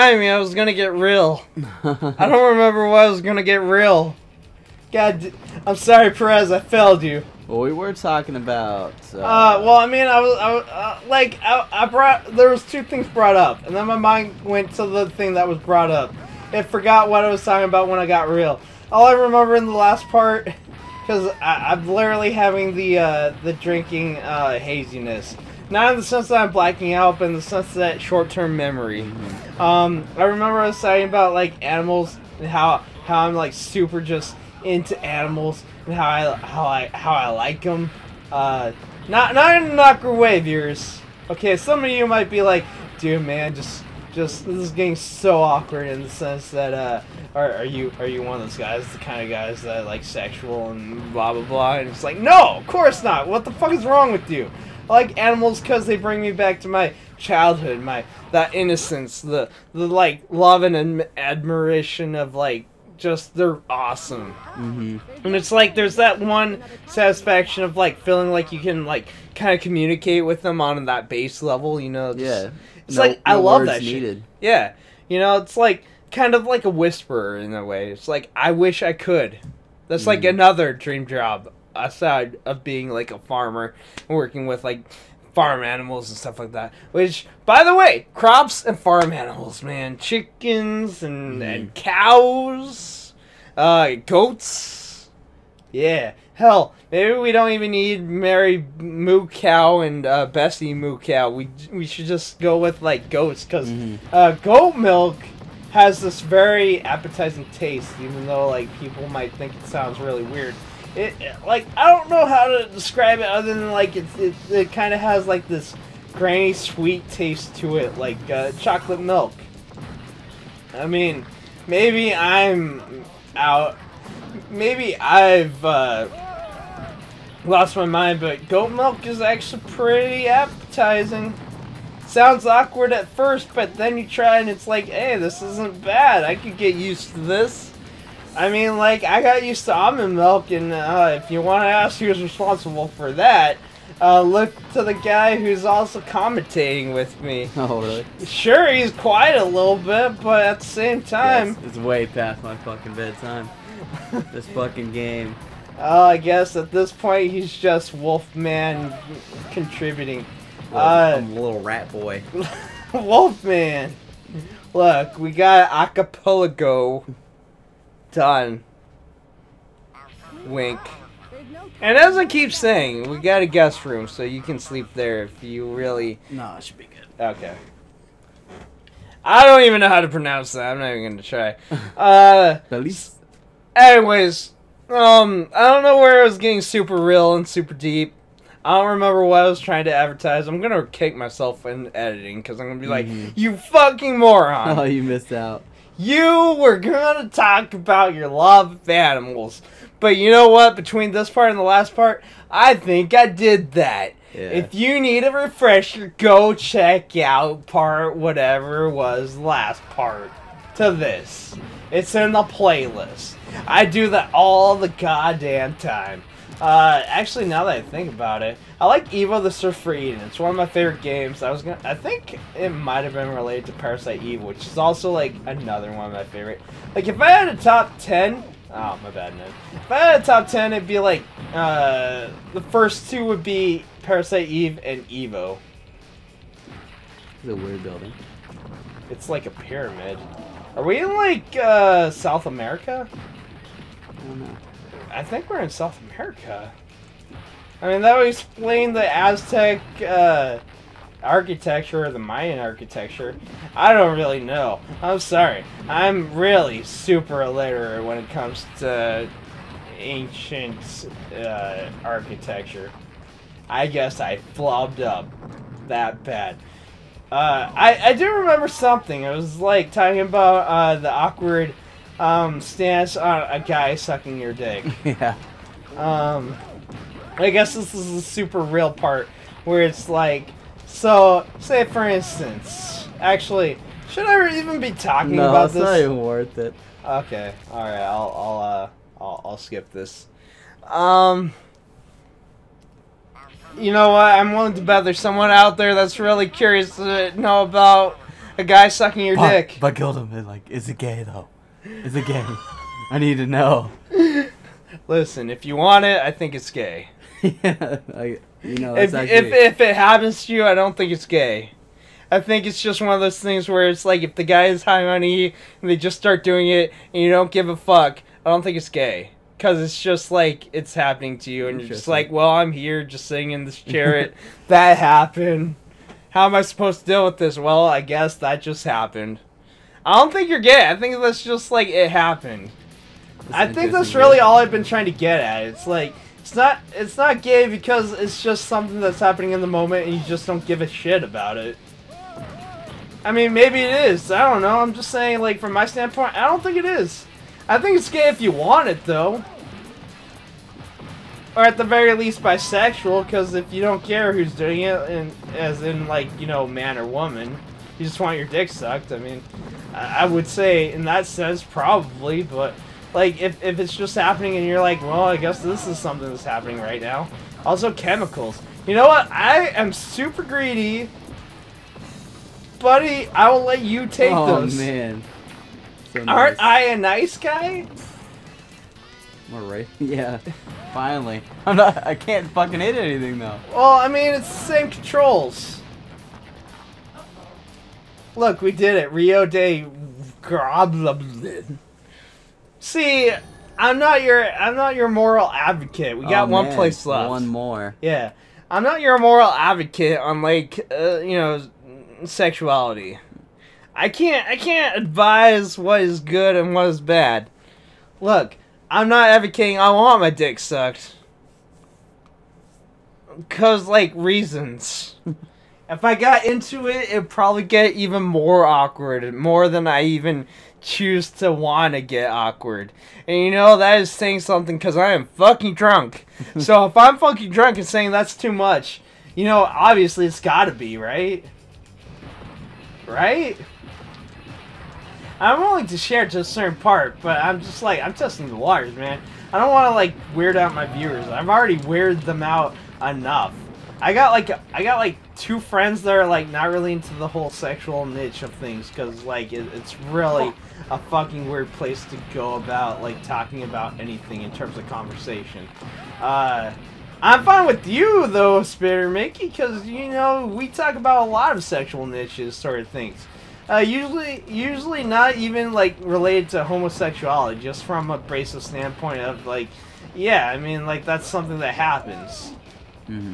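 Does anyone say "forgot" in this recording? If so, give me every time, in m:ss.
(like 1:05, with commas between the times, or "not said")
0:16.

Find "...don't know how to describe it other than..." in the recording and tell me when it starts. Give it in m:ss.
1:51.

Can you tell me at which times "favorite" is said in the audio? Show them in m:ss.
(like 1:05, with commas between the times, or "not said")
3:40, 3:46.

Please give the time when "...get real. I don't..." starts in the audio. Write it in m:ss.
0:00.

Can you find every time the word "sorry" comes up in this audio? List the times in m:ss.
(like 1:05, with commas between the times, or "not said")
0:05, 4:15.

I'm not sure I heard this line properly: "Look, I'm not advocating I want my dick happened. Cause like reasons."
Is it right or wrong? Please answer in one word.
wrong.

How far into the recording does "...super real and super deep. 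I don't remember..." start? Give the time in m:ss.
3:06.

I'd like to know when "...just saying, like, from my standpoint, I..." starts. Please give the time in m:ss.
5:44.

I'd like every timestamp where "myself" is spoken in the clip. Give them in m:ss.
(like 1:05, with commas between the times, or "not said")
3:11.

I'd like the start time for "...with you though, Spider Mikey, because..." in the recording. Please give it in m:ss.
7:37.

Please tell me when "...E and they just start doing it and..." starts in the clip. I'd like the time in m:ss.
5:15.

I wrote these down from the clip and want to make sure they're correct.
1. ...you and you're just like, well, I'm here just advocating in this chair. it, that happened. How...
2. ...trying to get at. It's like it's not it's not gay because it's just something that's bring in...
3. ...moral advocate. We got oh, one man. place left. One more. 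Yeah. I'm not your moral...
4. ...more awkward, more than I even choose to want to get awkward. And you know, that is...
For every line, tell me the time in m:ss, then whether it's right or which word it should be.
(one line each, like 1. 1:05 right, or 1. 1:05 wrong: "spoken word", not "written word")
1. 5:21 wrong: "sitting", not "advocating"
2. 5:34 wrong: "happening", not "bring"
3. 6:35 right
4. 6:58 right.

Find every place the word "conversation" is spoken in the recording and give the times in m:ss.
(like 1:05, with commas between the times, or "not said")
7:34.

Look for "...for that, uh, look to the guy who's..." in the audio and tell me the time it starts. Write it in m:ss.
2:22.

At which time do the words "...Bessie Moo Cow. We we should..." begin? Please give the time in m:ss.
1:40.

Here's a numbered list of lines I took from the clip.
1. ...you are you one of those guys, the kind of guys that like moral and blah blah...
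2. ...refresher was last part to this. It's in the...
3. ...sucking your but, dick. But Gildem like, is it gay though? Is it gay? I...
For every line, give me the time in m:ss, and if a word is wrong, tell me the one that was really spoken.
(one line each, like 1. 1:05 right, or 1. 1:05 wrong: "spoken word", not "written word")
1. 0:47 wrong: "sexual", not "moral"
2. 3:28 wrong: "whatever", not "refresher"
3. 4:58 right.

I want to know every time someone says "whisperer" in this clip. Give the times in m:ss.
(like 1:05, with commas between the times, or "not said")
1:16.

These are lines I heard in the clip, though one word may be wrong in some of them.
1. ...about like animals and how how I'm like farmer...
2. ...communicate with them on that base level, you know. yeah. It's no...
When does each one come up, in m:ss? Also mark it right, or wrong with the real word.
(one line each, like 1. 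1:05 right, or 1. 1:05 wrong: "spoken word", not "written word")
1. 0:31 wrong: "super", not "farmer"
2. 1:09 right.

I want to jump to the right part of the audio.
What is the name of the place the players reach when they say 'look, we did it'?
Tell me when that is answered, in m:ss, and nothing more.
6:29.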